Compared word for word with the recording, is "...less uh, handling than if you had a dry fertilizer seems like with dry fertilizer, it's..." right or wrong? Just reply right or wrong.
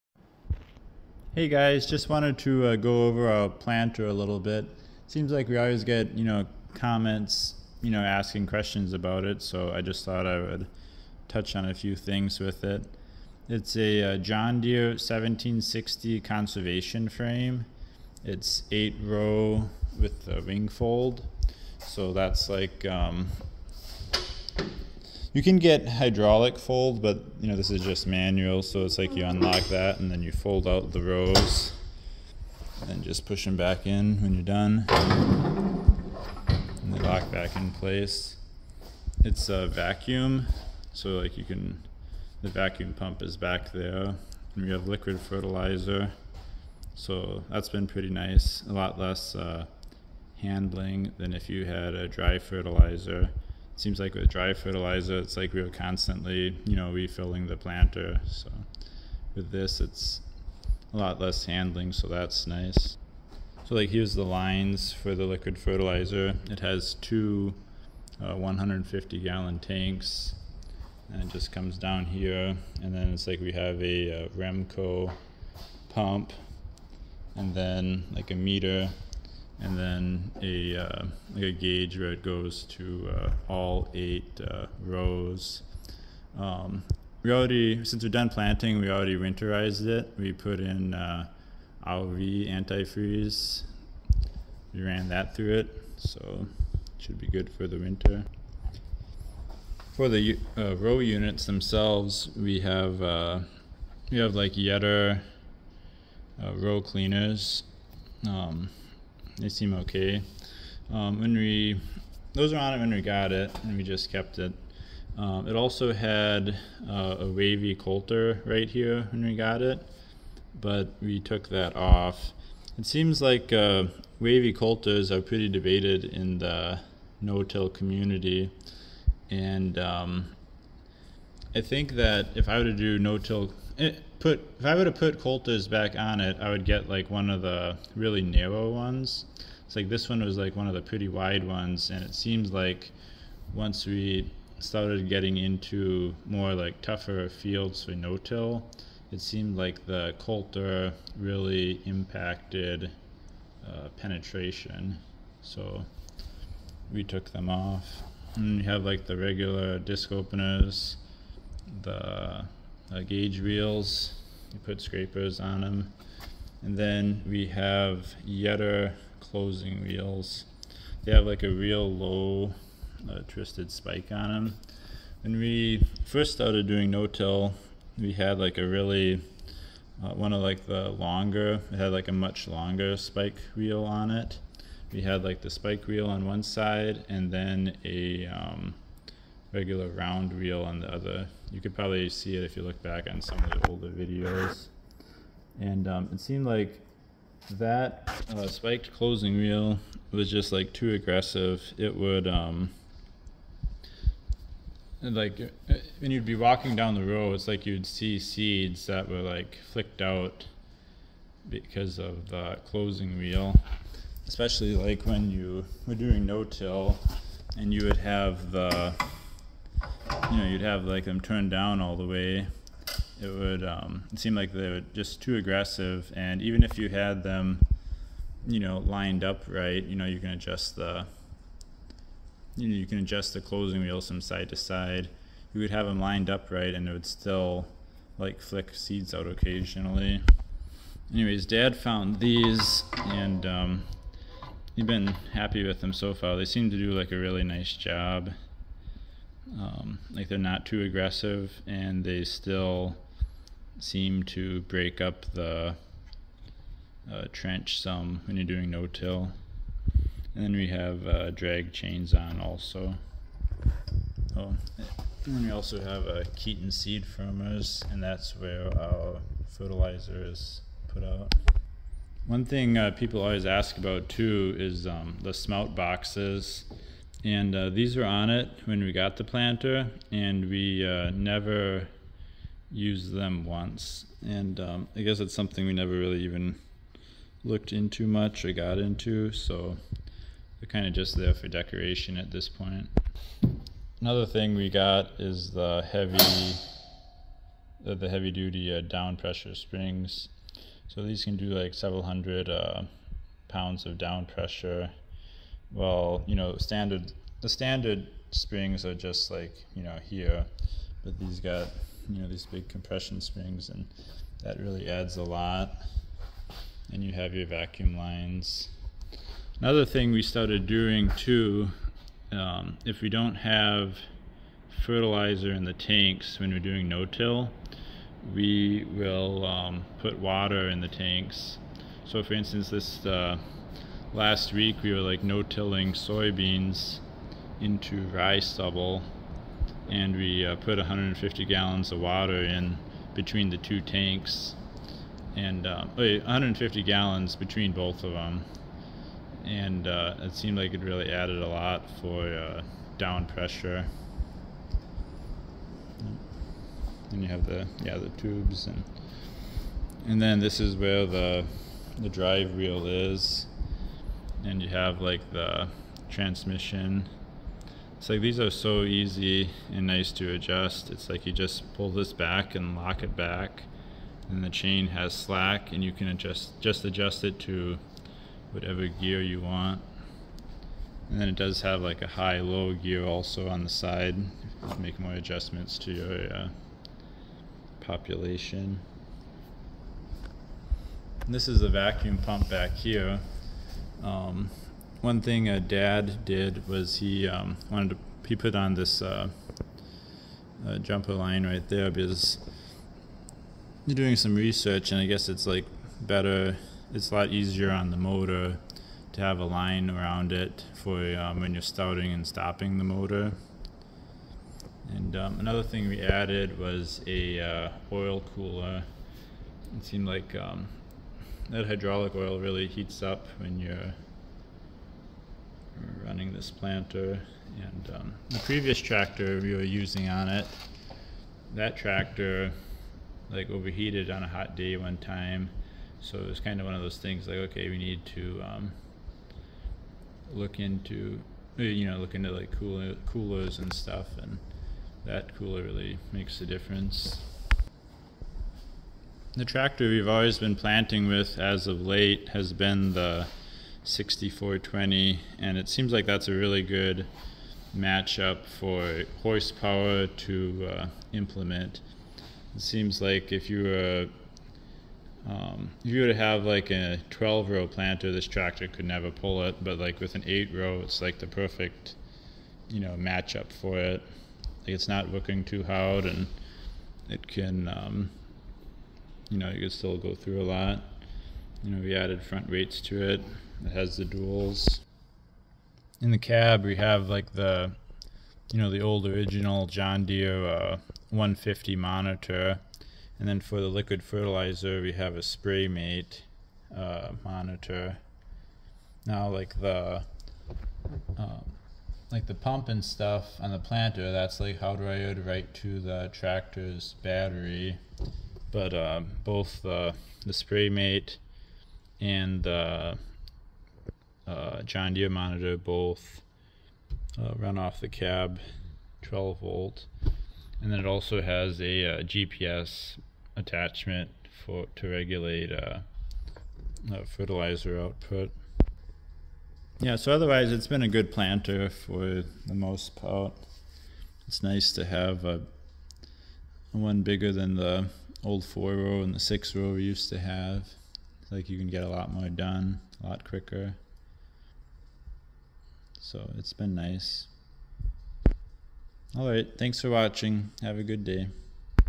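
right.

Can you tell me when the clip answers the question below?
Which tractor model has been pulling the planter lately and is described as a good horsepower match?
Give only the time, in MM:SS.
07:33.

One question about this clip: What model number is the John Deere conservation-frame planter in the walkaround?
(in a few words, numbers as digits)
1760.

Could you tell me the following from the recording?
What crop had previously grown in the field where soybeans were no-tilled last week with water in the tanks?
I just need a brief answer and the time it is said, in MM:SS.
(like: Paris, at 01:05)
rye, at 05:38.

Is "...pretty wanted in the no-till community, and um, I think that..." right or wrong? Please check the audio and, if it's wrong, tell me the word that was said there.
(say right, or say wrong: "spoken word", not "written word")
wrong: "debated", not "wanted".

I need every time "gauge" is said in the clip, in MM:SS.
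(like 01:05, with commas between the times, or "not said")
01:21, 02:43.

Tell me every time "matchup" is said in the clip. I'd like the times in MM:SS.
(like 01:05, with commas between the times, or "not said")
07:37, 07:52.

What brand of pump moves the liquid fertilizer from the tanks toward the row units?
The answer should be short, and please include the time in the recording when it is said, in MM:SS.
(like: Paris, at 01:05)
Remco, at 01:14.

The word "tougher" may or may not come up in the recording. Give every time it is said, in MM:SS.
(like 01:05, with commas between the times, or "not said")
02:26.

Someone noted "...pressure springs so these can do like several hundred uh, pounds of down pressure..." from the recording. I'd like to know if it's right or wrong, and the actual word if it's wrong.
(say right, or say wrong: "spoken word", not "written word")
right.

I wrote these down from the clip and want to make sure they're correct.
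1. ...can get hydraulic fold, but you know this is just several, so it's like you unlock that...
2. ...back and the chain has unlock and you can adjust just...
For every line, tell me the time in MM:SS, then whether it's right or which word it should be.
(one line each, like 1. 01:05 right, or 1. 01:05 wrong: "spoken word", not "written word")
1. 00:25 wrong: "manual", not "several"
2. 06:13 wrong: "slack", not "unlock".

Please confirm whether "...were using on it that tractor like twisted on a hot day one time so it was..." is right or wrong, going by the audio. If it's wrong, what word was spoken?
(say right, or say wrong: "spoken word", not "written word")
wrong: "overheated", not "twisted".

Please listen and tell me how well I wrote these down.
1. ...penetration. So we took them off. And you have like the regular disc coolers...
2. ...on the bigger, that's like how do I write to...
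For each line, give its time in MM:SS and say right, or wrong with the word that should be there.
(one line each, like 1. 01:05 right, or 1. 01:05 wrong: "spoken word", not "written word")
1. 02:33 wrong: "openers", not "coolers"
2. 08:23 wrong: "planter", not "bigger".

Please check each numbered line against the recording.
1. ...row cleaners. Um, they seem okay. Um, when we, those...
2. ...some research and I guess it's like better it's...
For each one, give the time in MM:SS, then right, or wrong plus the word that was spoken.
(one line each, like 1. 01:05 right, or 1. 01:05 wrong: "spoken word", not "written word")
1. 01:46 right
2. 06:44 right.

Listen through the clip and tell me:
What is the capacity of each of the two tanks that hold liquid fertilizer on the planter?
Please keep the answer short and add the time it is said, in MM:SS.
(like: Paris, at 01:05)
150 gallons, at 01:08.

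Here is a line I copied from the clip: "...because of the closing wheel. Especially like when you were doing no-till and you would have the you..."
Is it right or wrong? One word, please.
right.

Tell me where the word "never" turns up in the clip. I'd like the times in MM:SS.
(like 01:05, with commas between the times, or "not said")
04:41, 04:45, 07:48.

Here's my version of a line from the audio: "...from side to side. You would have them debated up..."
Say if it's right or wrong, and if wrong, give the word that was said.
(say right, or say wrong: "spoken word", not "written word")
wrong: "lined", not "debated".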